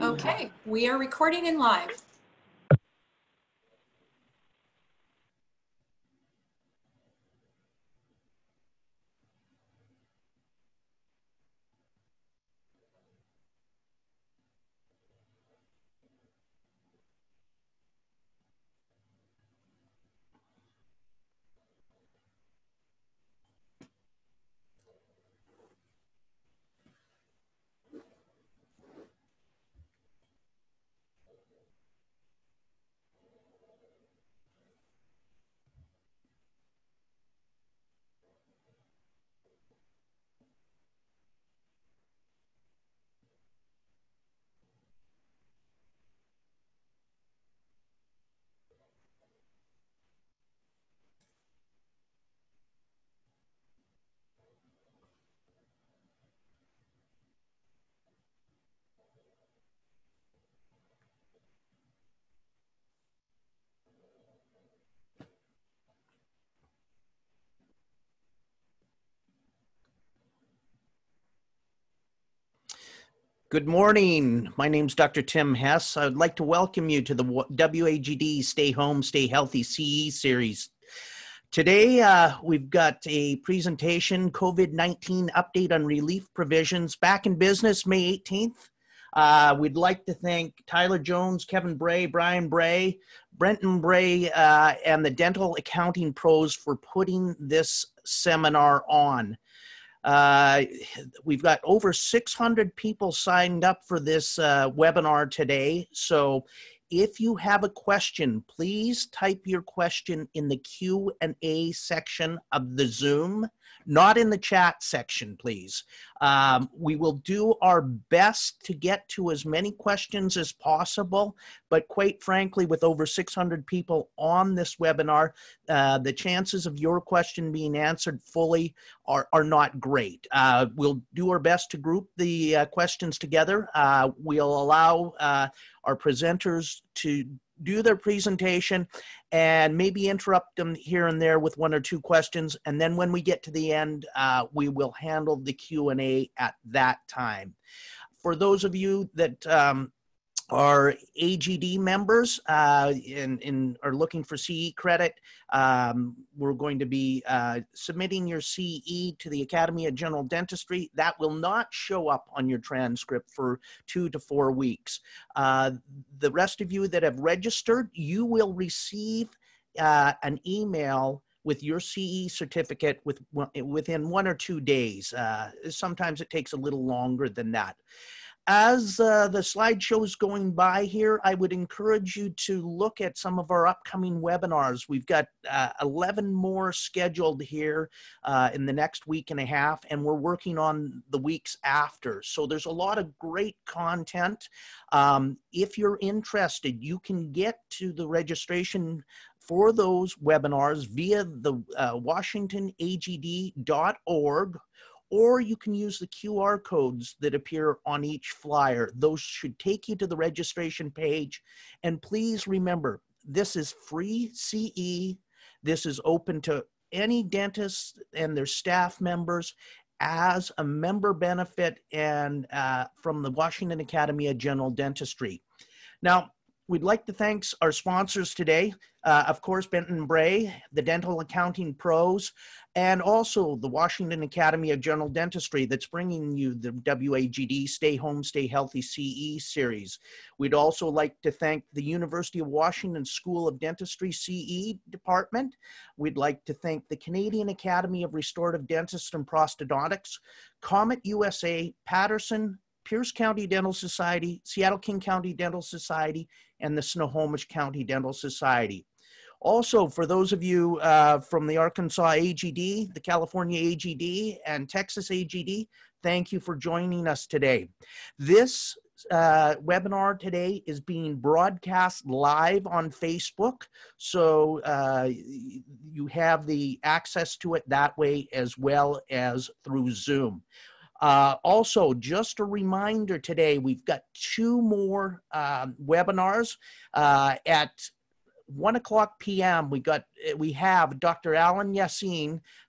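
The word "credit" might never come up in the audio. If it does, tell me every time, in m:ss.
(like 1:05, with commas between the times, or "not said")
2:34.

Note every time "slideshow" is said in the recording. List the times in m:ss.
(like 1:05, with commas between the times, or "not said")
2:59.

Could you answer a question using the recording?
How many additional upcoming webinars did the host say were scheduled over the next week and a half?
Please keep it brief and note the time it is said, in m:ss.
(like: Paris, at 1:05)
11, at 3:05.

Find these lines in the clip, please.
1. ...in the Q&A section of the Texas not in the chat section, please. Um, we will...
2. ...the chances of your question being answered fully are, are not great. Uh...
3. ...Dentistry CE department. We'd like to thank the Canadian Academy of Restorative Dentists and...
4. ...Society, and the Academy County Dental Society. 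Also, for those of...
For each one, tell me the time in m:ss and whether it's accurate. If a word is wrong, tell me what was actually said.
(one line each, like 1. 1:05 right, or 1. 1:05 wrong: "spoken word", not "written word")
1. 1:50 wrong: "Zoom", not "Texas"
2. 2:05 right
3. 4:03 right
4. 4:15 wrong: "Snohomish", not "Academy".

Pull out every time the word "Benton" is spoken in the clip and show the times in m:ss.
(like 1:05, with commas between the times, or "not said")
1:33, 3:49.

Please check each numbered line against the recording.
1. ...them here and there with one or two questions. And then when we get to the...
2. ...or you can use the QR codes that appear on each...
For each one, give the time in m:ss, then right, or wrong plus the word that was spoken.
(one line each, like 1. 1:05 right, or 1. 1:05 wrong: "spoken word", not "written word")
1. 2:20 right
2. 3:25 right.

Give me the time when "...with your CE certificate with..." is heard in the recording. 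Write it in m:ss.
2:51.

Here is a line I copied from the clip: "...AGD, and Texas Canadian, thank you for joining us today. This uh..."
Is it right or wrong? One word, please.
wrong.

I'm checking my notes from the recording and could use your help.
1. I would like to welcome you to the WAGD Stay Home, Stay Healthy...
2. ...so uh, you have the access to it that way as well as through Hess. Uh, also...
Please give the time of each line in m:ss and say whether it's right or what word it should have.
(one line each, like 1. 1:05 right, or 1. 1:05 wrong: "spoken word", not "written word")
1. 1:15 right
2. 4:33 wrong: "Zoom", not "Hess".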